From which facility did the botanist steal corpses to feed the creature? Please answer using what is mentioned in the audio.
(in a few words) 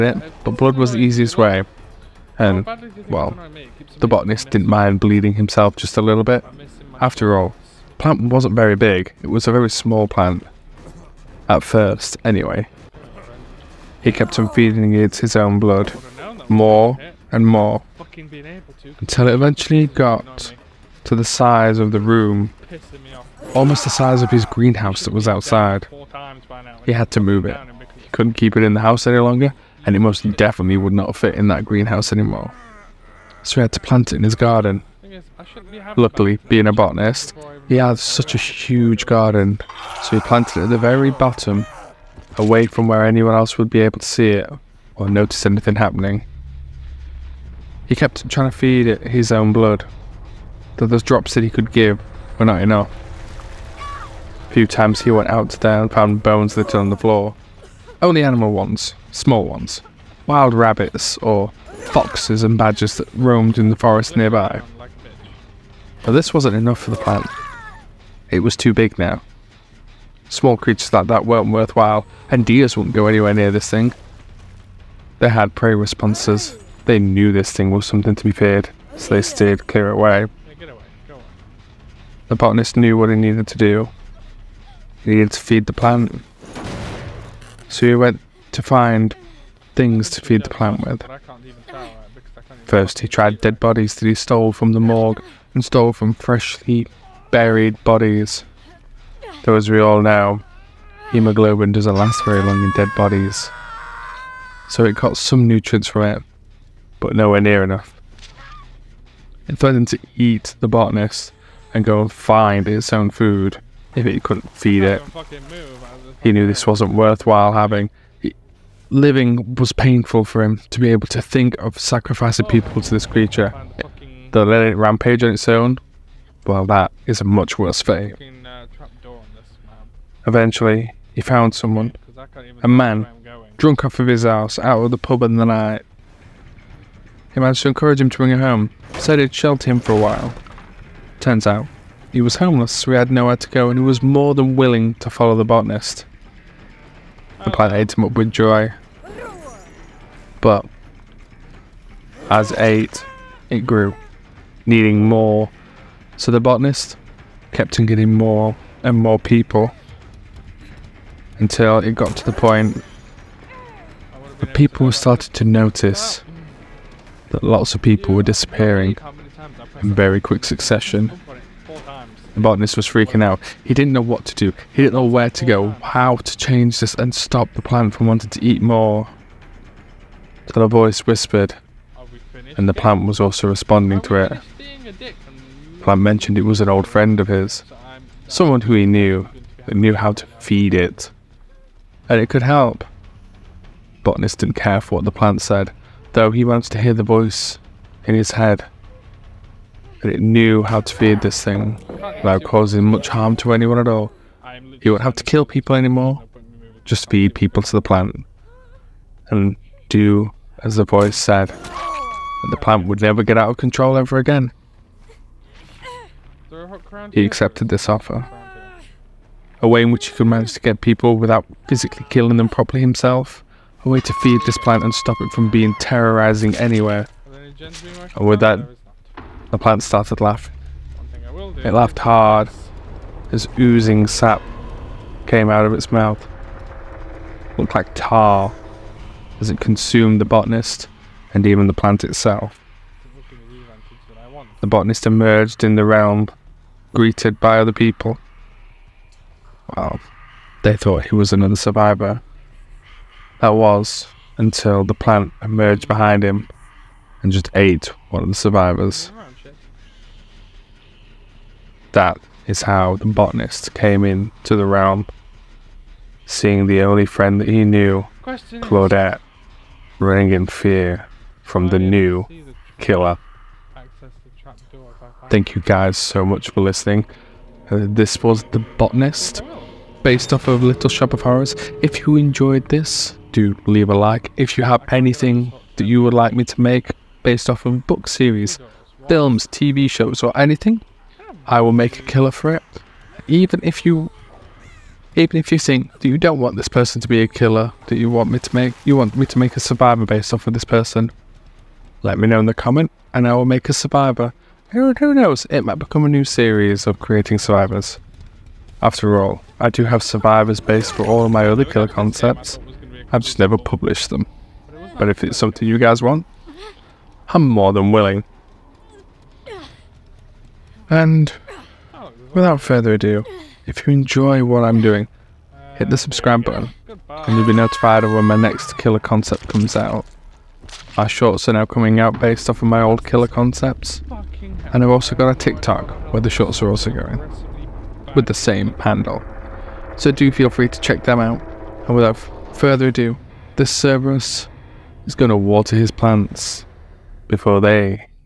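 The morgue.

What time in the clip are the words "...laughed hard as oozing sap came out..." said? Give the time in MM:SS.
03:51.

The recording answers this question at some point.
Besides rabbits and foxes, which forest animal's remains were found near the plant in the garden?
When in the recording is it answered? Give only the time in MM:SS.
01:02.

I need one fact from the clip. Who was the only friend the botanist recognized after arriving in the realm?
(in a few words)
Claudette.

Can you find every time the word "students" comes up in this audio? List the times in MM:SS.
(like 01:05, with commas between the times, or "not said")
not said.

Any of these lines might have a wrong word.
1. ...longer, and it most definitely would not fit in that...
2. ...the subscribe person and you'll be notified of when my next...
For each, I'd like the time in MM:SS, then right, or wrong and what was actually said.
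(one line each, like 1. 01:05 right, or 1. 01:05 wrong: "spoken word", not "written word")
1. 00:29 right
2. 05:25 wrong: "button", not "person".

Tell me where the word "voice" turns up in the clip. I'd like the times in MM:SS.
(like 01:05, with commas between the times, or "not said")
03:00, 03:17, 03:30.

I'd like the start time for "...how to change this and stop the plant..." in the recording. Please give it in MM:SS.
02:55.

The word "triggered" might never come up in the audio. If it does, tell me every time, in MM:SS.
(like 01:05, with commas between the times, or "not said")
not said.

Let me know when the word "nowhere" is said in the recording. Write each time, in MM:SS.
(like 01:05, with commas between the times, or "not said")
01:47, 02:23.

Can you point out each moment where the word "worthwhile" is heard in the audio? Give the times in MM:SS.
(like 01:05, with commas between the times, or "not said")
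01:11, 01:56.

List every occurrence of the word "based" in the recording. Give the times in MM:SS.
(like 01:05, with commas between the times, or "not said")
04:40, 04:47, 05:00, 05:10, 05:32.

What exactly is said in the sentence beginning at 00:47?
He kept trying to feed it his own blood, though those drops that he could give were not enough.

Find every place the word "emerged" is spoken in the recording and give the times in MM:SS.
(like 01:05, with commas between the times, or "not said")
04:05, 04:15.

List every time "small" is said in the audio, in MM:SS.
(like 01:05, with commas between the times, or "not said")
00:09, 00:59, 01:10.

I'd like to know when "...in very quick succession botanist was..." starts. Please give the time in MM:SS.
02:49.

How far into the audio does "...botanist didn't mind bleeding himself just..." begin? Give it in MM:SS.
00:04.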